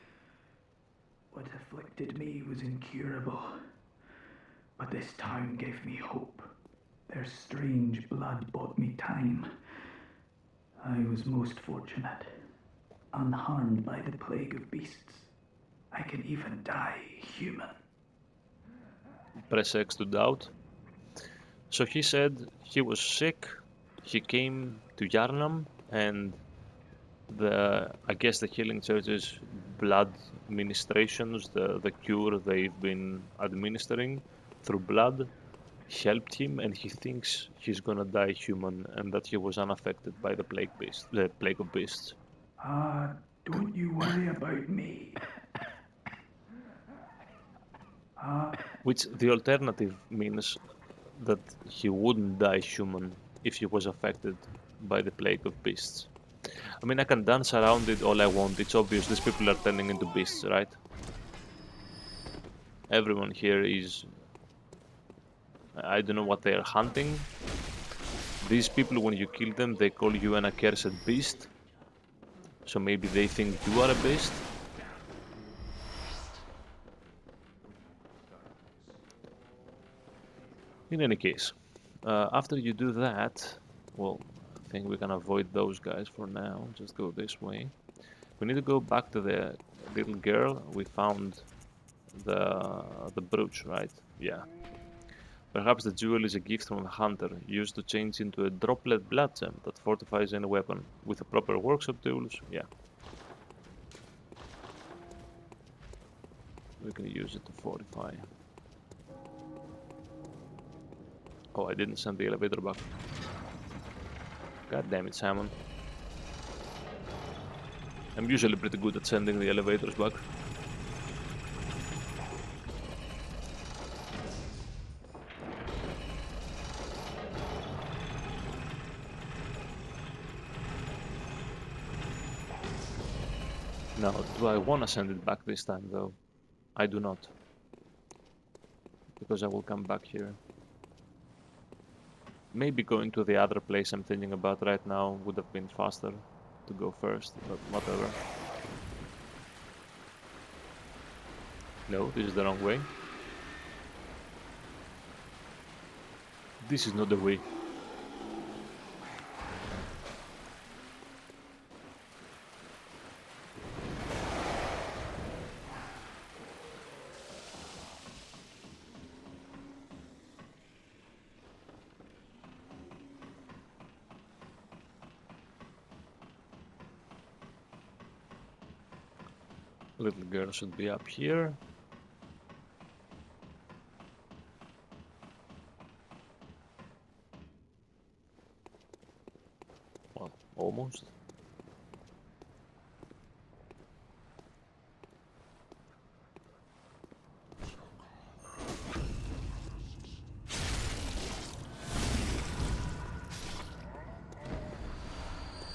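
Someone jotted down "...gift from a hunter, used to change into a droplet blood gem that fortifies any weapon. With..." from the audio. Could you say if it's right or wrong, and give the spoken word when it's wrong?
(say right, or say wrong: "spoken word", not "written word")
right.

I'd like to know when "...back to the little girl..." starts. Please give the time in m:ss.
1:28.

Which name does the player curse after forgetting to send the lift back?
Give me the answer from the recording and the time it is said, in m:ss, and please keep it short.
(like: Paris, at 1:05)
Simon, at 1:55.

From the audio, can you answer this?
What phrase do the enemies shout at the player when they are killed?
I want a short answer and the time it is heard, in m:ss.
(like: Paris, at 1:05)
accursed beast, at 1:10.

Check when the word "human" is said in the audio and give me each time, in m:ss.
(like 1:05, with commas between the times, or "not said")
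0:17, 0:38, 0:52.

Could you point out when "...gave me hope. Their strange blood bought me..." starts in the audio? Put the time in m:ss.
0:05.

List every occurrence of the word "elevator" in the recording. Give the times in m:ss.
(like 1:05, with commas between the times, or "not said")
1:52, 1:59.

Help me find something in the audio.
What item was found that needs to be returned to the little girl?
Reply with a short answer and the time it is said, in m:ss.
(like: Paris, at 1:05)
the brooch, at 1:33.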